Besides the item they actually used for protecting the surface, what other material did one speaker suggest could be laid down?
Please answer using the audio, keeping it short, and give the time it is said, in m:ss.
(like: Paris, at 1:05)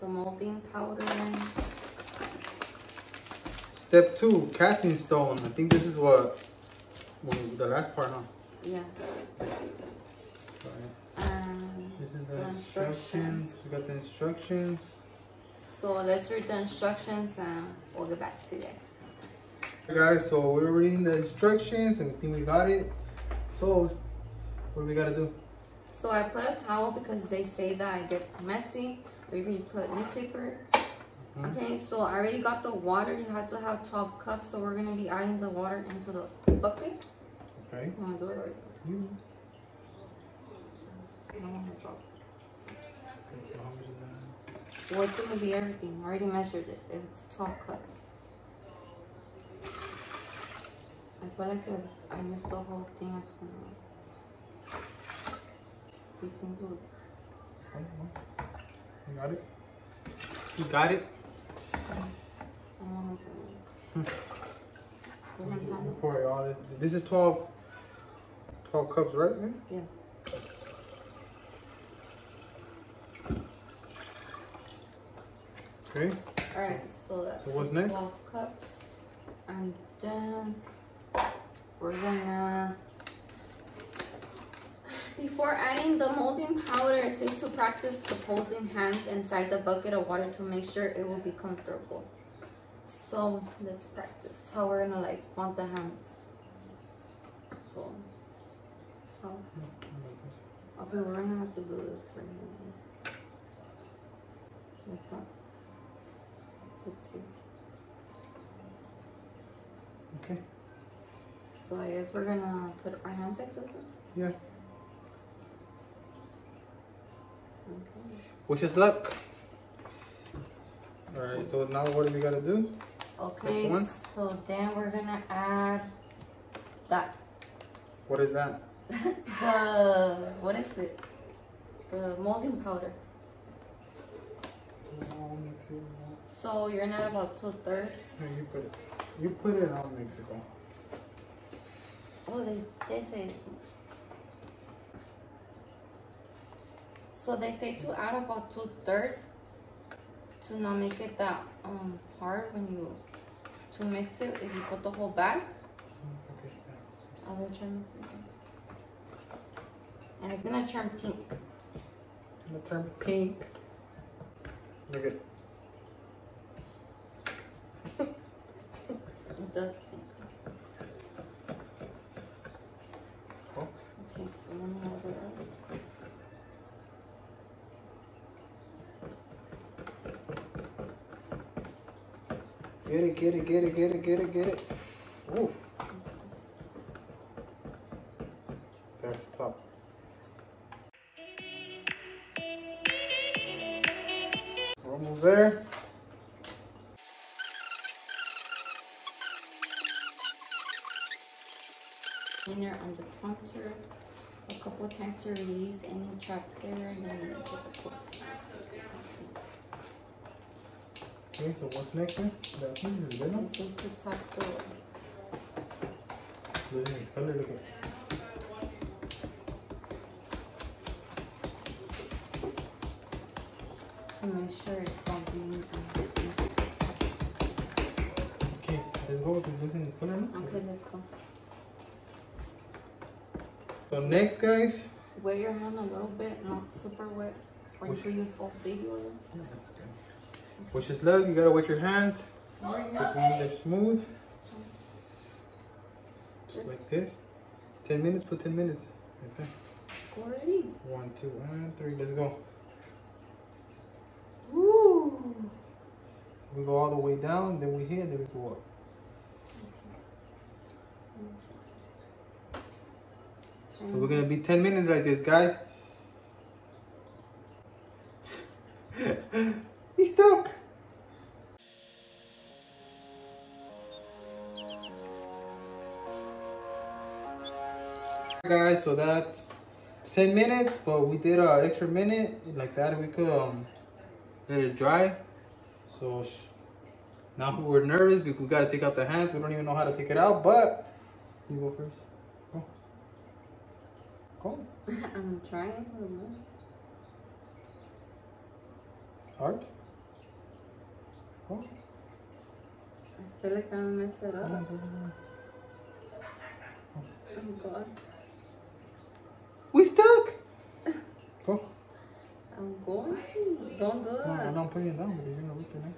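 newspaper, at 0:29.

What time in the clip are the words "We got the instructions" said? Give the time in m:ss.
0:13.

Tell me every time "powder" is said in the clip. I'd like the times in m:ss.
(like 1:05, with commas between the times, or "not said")
0:00, 1:26, 2:12.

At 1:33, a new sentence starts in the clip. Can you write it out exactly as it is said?
So let's practice how we're gonna like want the hands.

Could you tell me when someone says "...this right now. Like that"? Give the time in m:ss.
1:41.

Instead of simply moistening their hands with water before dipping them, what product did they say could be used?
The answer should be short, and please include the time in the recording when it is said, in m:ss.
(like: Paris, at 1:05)
baby oil, at 3:58.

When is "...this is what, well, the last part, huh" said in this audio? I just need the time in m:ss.
0:05.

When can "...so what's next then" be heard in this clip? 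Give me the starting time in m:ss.
3:31.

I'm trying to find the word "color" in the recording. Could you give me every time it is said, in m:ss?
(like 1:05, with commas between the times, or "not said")
3:37, 3:49.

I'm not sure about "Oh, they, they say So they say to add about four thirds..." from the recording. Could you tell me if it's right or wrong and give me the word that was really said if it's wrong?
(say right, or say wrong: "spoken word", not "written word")
wrong: "two", not "four".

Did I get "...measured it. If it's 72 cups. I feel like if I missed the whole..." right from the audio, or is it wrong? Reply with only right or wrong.
wrong.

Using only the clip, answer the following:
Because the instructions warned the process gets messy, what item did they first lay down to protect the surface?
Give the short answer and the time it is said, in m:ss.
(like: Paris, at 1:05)
towel, at 0:26.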